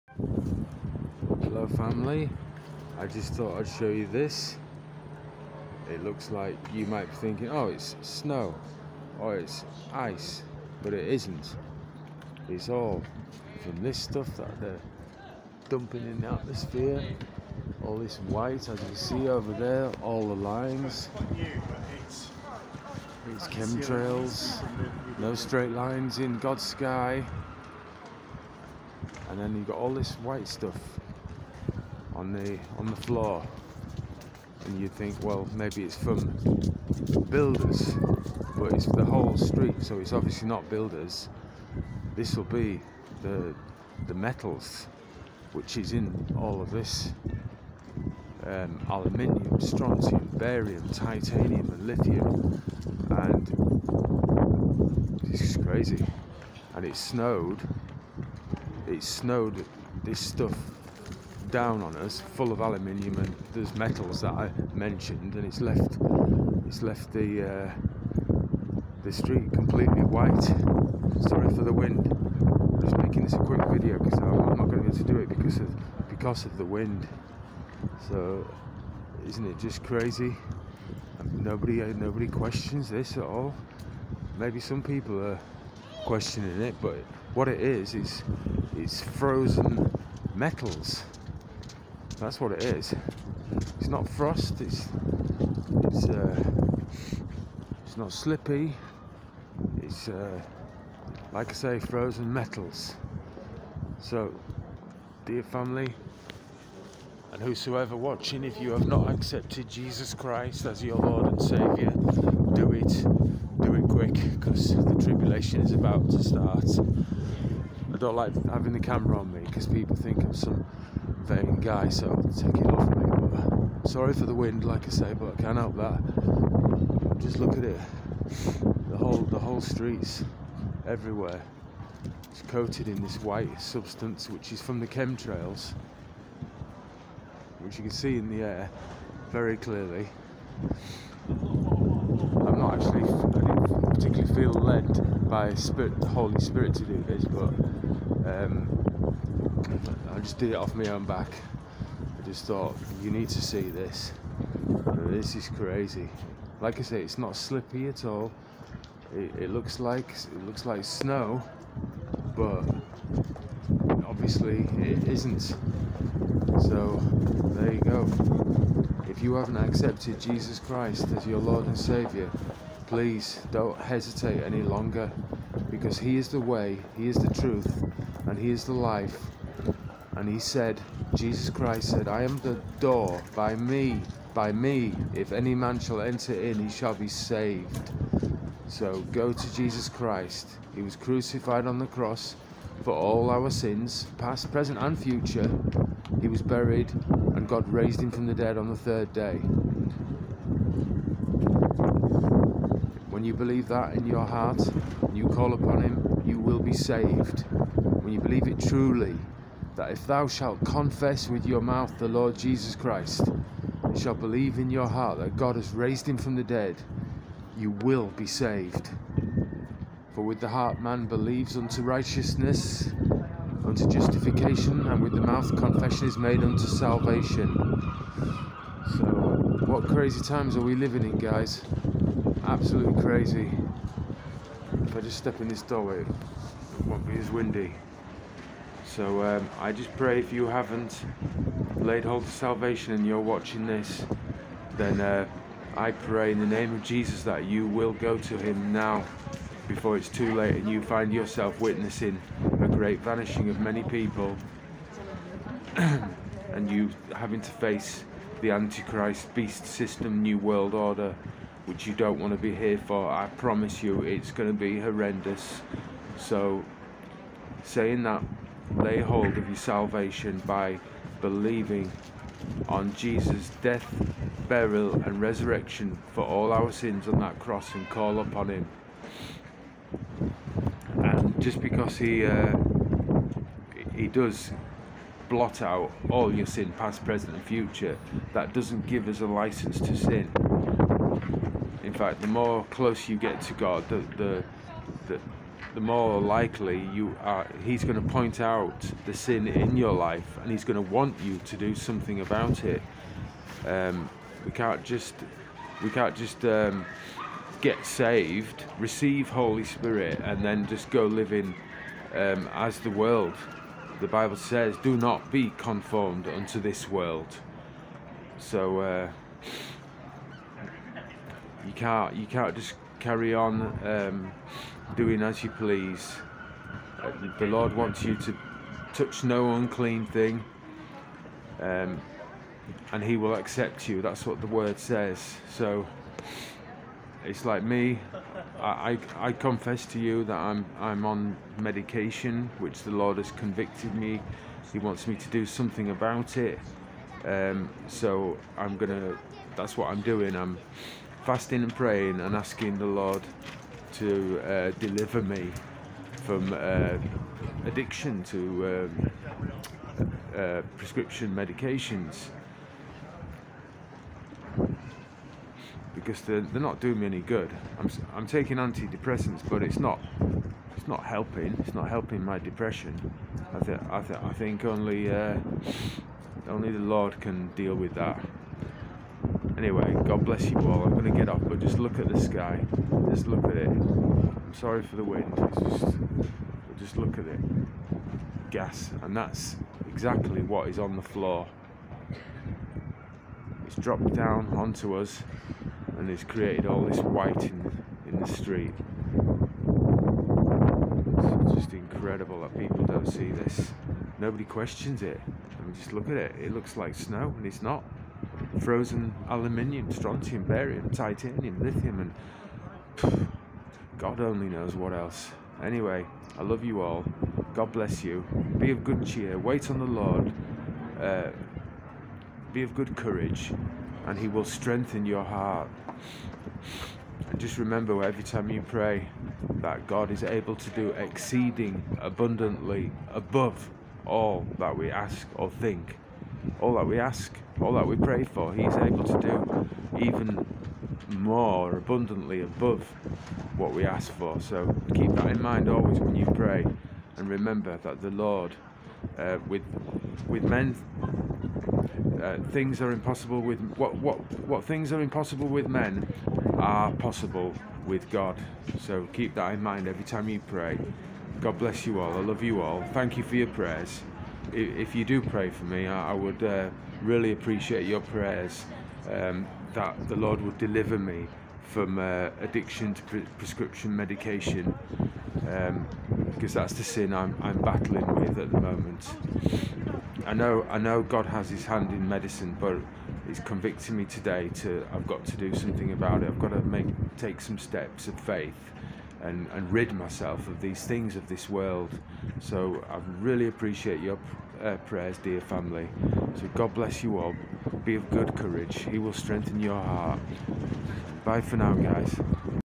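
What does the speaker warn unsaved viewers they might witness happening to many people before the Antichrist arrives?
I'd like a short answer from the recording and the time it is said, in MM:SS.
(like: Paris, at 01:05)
a great vanishing, at 04:12.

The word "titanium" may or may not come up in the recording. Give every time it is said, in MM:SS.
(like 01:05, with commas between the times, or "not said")
00:50, 06:50.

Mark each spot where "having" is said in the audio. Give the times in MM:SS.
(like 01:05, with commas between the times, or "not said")
01:58, 04:17.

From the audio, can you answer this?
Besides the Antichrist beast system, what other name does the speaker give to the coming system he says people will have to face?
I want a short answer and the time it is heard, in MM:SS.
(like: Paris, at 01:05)
New World Order, at 04:20.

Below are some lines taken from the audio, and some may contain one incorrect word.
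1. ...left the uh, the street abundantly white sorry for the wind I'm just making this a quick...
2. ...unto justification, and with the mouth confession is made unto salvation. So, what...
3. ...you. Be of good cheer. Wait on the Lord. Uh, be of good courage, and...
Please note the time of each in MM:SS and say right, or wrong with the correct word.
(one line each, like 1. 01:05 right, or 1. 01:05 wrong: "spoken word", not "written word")
1. 01:06 wrong: "completely", not "abundantly"
2. 03:43 right
3. 06:58 right.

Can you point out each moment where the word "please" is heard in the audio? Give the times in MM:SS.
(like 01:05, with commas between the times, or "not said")
02:52, 05:25.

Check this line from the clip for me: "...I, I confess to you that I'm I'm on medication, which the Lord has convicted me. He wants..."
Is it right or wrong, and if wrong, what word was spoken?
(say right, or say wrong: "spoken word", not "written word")
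right.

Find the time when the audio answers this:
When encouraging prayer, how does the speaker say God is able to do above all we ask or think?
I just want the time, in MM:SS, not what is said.
07:10.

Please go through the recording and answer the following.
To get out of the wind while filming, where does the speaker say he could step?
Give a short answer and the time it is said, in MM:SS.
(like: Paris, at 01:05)
doorway, at 03:55.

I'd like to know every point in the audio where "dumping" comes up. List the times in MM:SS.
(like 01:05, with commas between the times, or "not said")
00:15.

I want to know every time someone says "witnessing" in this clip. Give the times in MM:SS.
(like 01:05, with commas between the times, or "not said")
04:11.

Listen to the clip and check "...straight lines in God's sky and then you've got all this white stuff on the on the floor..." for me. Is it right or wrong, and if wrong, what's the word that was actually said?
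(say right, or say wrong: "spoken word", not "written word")
right.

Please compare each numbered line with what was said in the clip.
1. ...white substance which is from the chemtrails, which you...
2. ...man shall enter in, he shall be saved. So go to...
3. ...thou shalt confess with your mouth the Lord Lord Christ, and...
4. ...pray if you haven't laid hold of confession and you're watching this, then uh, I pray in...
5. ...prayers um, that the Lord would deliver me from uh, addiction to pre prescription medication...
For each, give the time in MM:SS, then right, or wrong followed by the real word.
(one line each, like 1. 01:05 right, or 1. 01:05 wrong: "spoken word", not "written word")
1. 02:13 right
2. 03:05 right
3. 03:30 wrong: "Jesus", not "Lord"
4. 03:59 wrong: "salvation", not "confession"
5. 07:48 right.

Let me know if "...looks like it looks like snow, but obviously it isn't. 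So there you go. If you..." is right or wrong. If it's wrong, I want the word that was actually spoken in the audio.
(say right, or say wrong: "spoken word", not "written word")
right.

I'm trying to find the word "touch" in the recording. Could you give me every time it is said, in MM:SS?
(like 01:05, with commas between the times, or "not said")
05:28.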